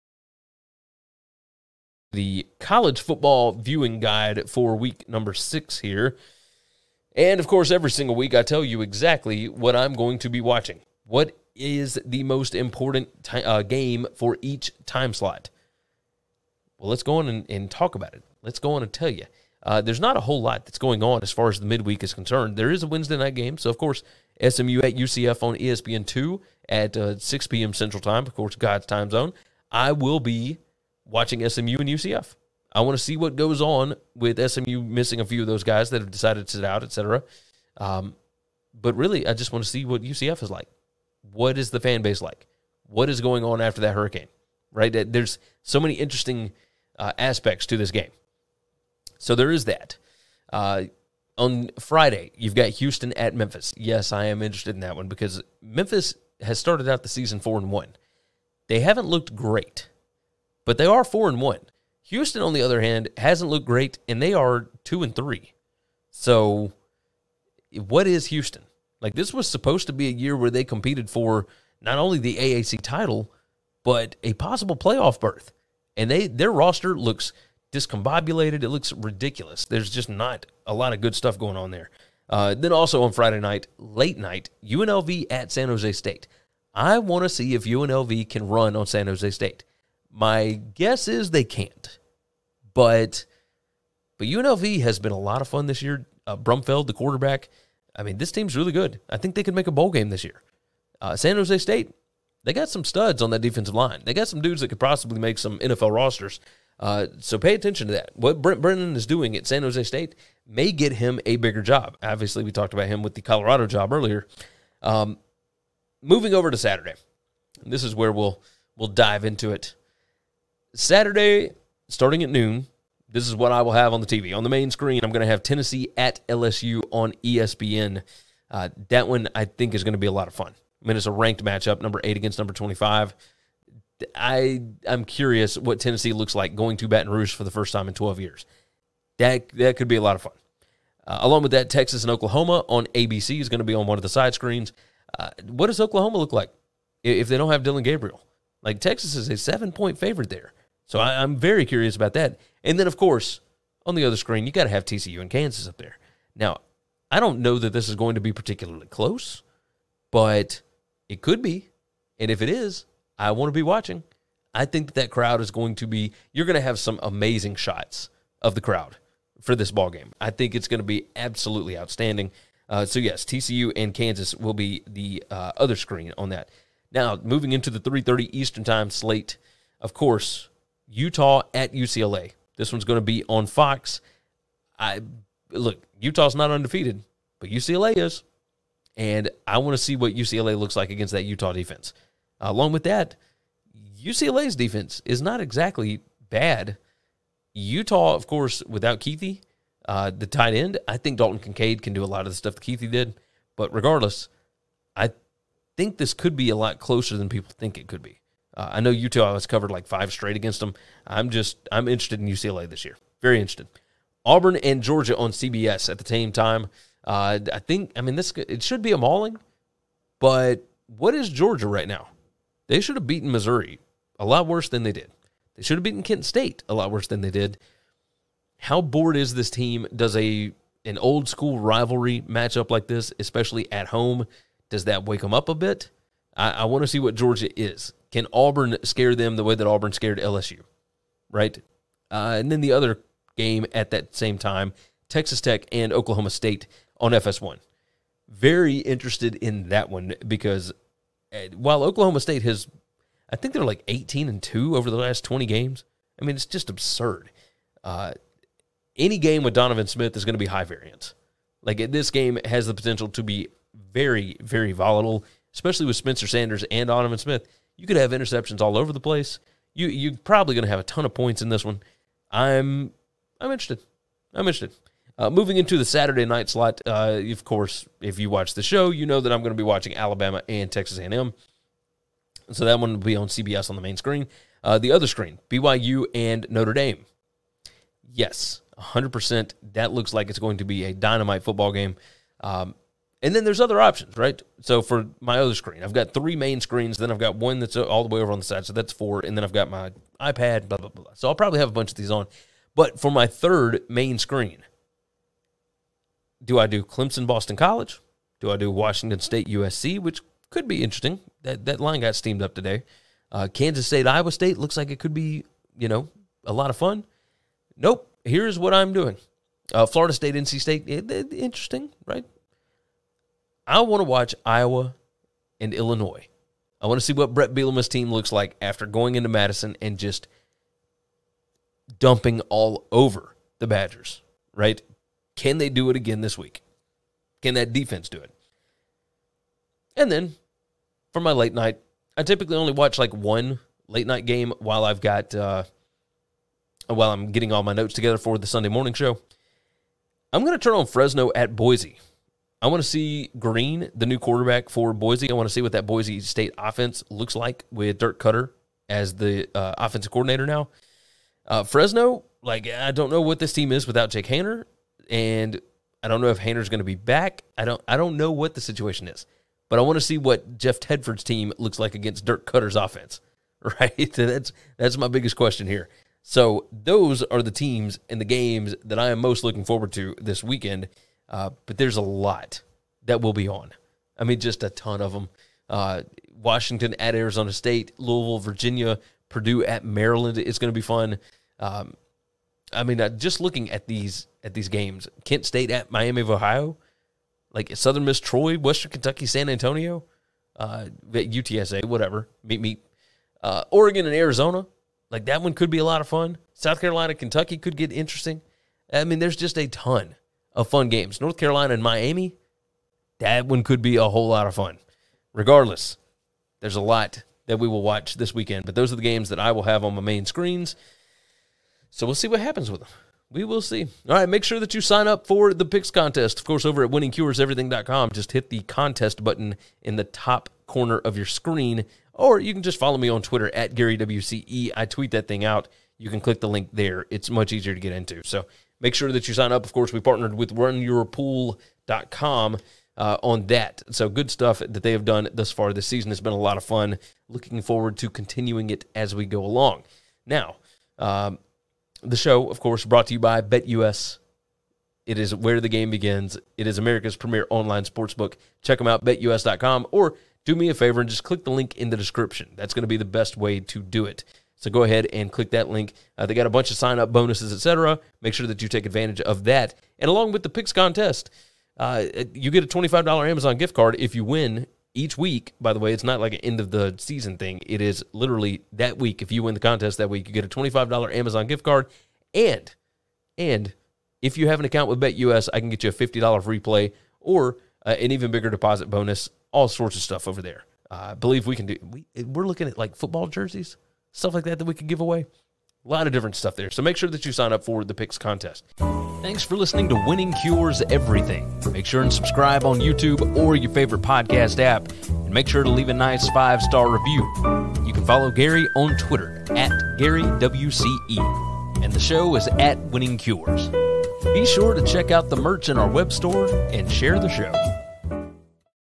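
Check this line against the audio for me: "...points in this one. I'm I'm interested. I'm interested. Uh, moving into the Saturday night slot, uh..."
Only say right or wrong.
right.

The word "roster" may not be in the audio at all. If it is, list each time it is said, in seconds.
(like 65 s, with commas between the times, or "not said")
76 s, 105 s.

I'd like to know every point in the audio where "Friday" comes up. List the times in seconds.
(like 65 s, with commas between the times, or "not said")
51 s, 83 s.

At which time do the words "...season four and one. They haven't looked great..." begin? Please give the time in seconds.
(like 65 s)
57 s.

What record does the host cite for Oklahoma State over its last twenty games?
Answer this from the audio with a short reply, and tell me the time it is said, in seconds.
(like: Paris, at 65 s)
18-2, at 253 s.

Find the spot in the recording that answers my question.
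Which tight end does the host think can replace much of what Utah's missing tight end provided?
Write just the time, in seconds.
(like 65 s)
201 s.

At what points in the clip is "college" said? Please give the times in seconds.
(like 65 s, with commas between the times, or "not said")
2 s, 307 s.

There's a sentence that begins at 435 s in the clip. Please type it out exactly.
You can click the link there.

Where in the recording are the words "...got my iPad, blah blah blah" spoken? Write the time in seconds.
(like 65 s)
299 s.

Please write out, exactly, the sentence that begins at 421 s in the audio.
So we'll see what happens with them.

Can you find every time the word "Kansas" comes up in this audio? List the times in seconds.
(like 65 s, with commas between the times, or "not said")
155 s, 173 s, 313 s.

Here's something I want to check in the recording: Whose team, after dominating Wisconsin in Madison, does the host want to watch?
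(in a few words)
Bret Bielema.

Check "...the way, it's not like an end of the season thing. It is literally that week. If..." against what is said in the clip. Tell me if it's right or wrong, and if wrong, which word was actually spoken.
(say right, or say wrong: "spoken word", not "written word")
right.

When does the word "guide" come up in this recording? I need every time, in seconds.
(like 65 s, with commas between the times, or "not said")
3 s.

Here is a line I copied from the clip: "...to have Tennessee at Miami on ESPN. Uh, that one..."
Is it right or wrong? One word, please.
wrong.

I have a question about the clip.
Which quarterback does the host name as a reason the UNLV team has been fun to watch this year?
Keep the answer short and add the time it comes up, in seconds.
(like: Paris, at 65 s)
Brumfield, at 96 s.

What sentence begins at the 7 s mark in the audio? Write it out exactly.
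And of course, every single week I tell you exactly what I'm going to be watching.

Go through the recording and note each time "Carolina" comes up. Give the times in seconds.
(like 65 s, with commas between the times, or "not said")
406 s, 411 s.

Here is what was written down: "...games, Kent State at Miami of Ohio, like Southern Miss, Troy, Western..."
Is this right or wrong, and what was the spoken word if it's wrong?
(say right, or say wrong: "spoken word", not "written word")
right.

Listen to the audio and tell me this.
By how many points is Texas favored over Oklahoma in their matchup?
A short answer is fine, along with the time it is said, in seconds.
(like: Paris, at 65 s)
7, at 149 s.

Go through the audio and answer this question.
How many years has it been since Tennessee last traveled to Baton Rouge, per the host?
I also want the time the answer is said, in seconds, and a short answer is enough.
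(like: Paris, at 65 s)
12, at 137 s.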